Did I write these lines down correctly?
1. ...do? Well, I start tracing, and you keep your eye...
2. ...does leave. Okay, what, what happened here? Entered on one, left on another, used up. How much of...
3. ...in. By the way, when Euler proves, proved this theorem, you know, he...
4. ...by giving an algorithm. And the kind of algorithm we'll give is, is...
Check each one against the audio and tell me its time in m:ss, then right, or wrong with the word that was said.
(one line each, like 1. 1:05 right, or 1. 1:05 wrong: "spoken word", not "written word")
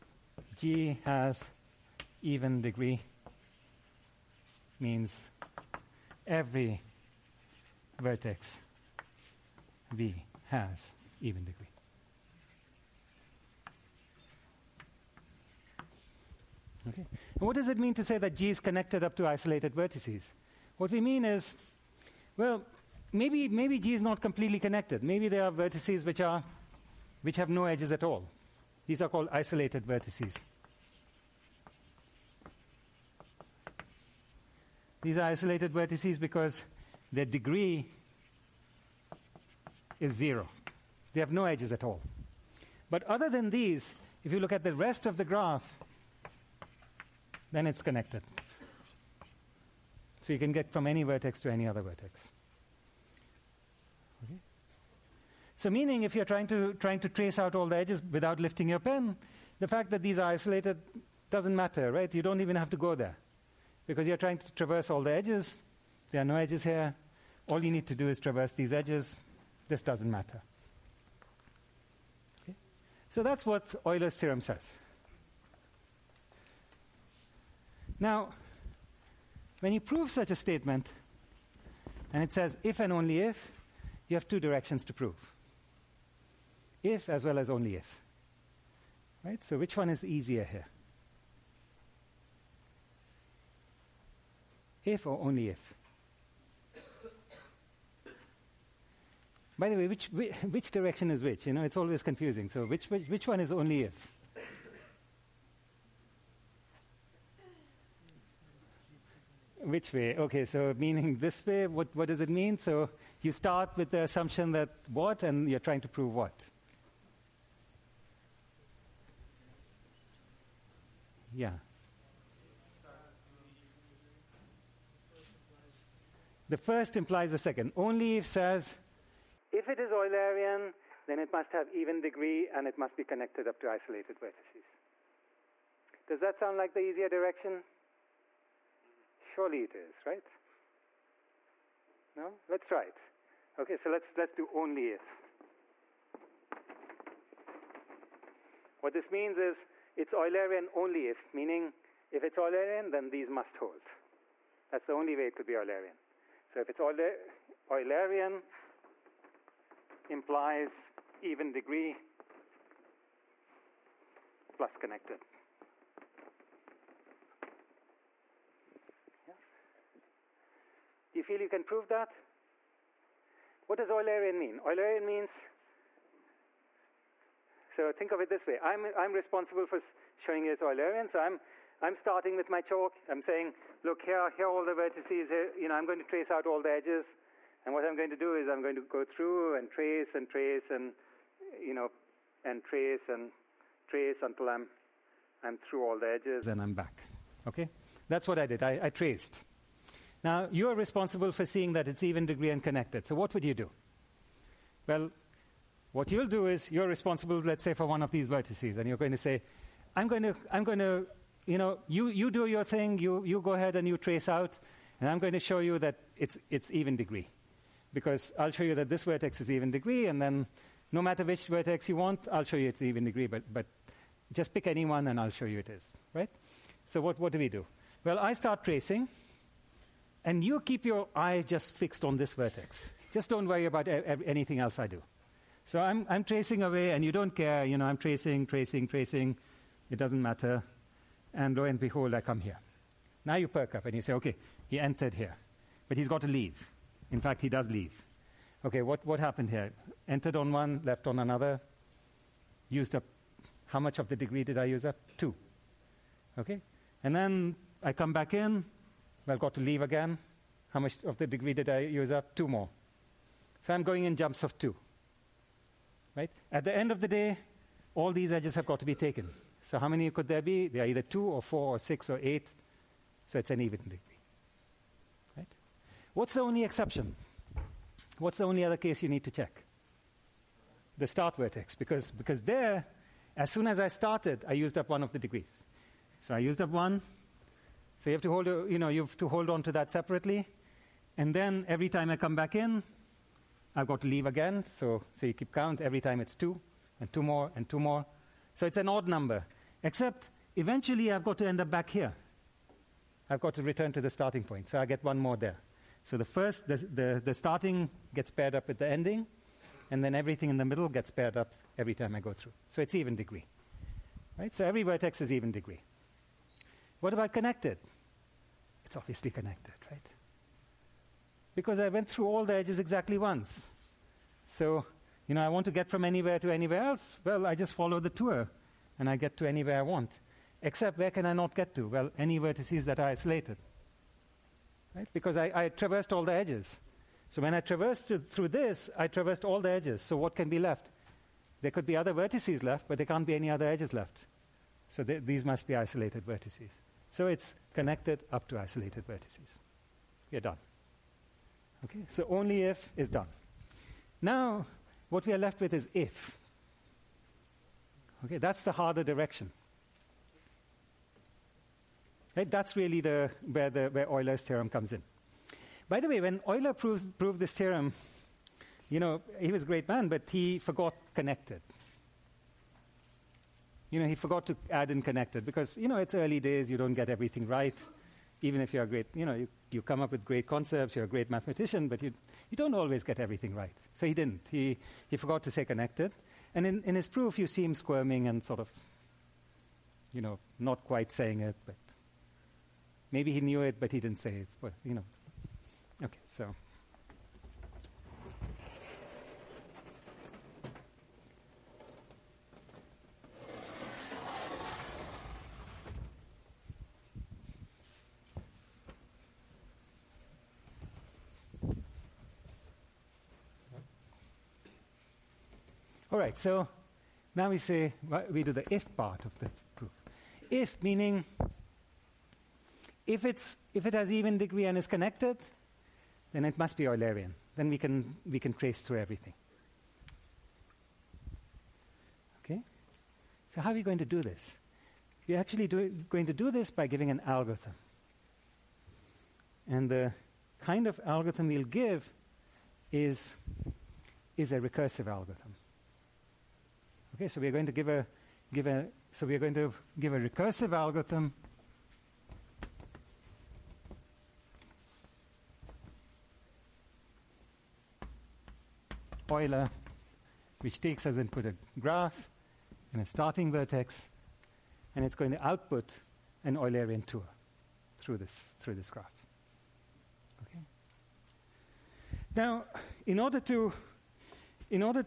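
1. 3:47 right
2. 4:07 right
3. 6:04 right
4. 7:16 right.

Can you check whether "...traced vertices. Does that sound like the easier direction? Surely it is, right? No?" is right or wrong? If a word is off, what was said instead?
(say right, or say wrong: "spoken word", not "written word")
wrong: "isolated", not "traced".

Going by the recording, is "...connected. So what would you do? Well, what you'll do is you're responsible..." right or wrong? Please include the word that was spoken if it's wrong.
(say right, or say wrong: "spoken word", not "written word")
right.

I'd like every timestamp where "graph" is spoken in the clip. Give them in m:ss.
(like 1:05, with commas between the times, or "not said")
0:45, 7:41, 7:48.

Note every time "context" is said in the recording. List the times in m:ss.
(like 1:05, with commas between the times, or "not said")
not said.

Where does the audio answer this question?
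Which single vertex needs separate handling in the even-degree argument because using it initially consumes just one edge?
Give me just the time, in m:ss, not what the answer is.
4:40.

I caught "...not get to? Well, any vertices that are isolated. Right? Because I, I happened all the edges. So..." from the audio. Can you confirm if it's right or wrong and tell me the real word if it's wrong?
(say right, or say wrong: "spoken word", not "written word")
wrong: "traversed", not "happened".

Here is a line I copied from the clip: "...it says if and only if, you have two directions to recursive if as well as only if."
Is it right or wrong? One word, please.
wrong.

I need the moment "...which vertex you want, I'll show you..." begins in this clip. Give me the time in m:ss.
3:41.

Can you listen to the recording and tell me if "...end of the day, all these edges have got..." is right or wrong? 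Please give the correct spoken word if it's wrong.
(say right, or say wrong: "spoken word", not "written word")
right.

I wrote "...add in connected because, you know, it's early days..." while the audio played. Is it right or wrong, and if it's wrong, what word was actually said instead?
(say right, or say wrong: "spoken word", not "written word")
right.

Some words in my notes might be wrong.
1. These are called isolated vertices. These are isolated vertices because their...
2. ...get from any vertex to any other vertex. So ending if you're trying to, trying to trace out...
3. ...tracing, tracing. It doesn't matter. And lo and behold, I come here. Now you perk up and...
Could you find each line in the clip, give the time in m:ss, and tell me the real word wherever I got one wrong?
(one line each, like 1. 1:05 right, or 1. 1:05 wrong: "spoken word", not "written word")
1. 0:28 right
2. 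0:50 wrong: "meaning", not "ending"
3. 3:58 right.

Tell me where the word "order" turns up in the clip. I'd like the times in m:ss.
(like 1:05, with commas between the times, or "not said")
7:53.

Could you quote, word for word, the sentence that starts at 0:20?
What we mean is, well, maybe, maybe G is not completely connected.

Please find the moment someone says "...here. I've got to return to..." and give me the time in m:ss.
5:01.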